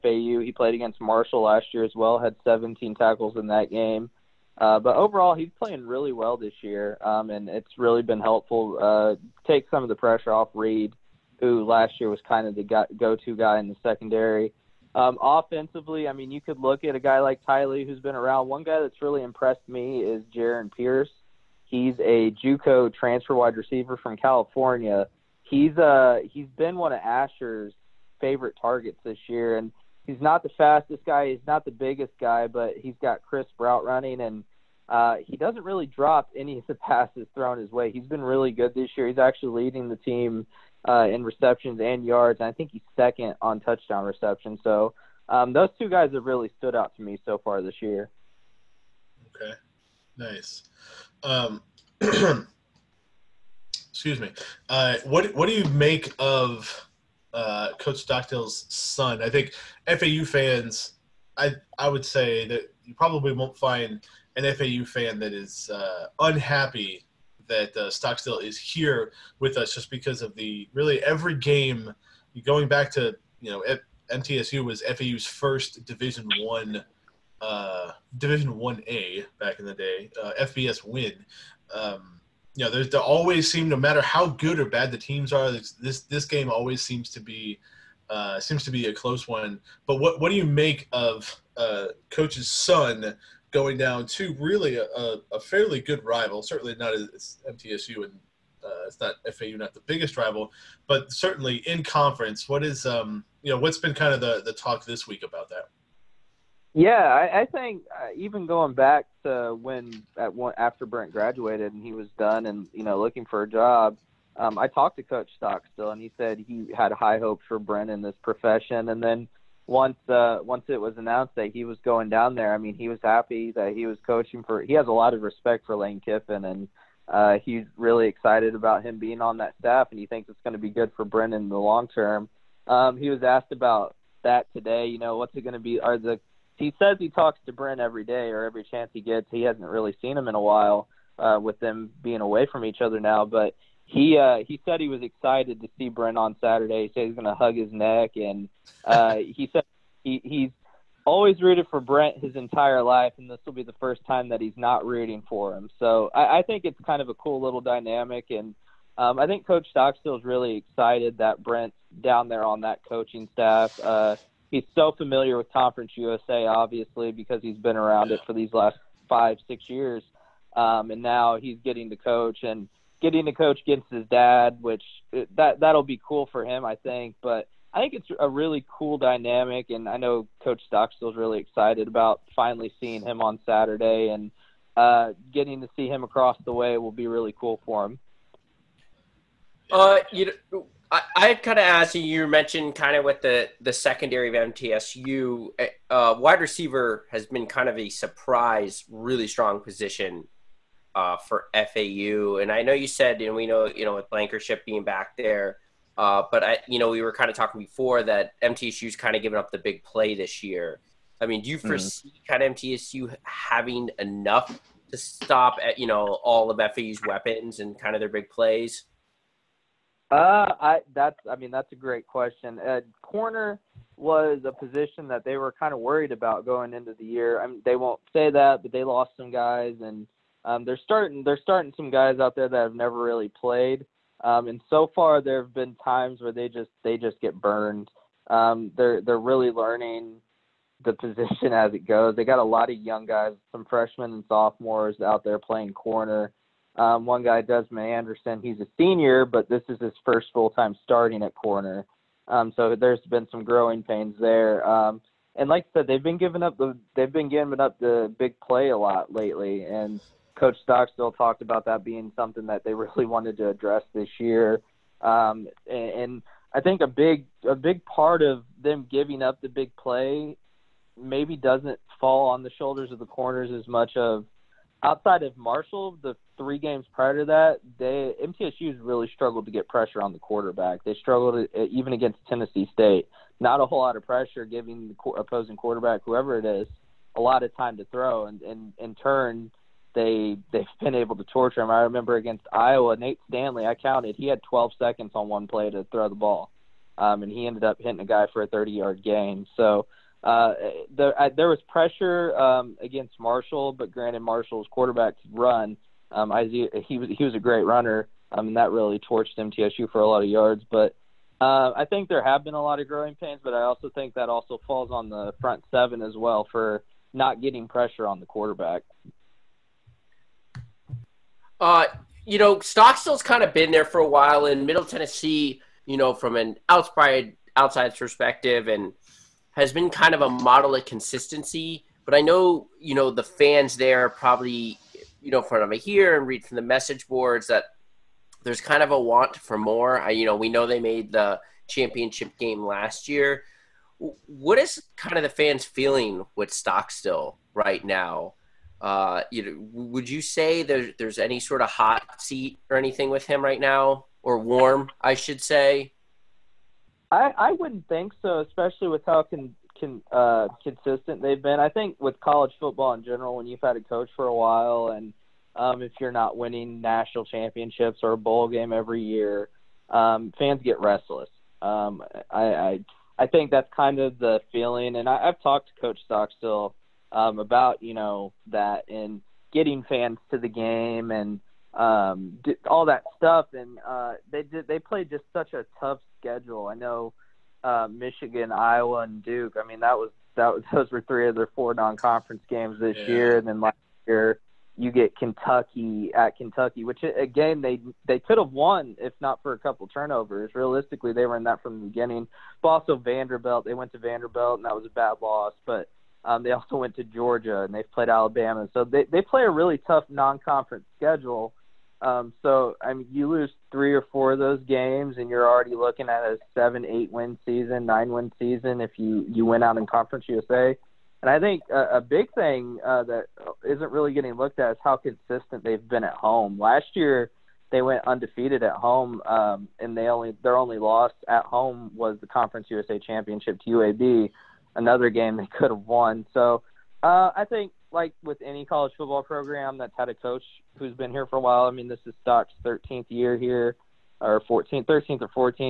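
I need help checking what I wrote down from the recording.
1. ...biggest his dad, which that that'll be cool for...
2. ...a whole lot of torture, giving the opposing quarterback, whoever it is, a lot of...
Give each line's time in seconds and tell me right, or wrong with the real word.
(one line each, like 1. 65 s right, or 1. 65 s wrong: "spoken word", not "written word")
1. 173 s wrong: "against", not "biggest"
2. 283 s wrong: "pressure", not "torture".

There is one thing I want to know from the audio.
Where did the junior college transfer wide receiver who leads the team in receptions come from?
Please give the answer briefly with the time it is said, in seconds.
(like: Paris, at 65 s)
California, at 24 s.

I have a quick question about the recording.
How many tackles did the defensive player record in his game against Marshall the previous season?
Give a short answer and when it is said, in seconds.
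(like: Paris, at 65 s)
17, at 2 s.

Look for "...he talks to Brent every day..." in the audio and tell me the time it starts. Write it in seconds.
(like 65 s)
136 s.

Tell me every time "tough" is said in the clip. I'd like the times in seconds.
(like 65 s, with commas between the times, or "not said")
385 s, 409 s.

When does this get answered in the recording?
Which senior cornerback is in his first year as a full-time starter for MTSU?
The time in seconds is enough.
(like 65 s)
247 s.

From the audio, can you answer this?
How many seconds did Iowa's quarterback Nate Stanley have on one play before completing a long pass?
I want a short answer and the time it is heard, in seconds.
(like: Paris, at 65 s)
12, at 294 s.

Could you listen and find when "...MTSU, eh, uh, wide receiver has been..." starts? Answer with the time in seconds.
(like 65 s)
194 s.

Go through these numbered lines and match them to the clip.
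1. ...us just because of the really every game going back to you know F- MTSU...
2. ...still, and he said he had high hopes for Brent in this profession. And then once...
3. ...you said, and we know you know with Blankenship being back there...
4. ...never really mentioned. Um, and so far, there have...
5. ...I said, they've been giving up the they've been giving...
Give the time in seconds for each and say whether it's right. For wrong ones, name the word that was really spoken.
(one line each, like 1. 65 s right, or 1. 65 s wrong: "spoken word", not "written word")
1. 69 s right
2. 115 s right
3. 202 s right
4. 232 s wrong: "played", not "mentioned"
5. 255 s right.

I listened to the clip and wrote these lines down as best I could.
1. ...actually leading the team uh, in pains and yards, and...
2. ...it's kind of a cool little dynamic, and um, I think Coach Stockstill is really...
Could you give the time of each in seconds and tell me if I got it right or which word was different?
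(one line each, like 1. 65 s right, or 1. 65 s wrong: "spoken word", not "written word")
1. 39 s wrong: "receptions", not "pains"
2. 156 s right.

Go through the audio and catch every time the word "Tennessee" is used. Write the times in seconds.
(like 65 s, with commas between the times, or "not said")
282 s, 324 s.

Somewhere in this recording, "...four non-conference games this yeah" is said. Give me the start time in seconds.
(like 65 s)
391 s.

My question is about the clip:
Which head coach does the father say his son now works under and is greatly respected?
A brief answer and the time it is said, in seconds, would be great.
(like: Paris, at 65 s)
Lane Kiffin, at 125 s.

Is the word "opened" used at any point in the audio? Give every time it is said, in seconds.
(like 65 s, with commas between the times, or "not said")
not said.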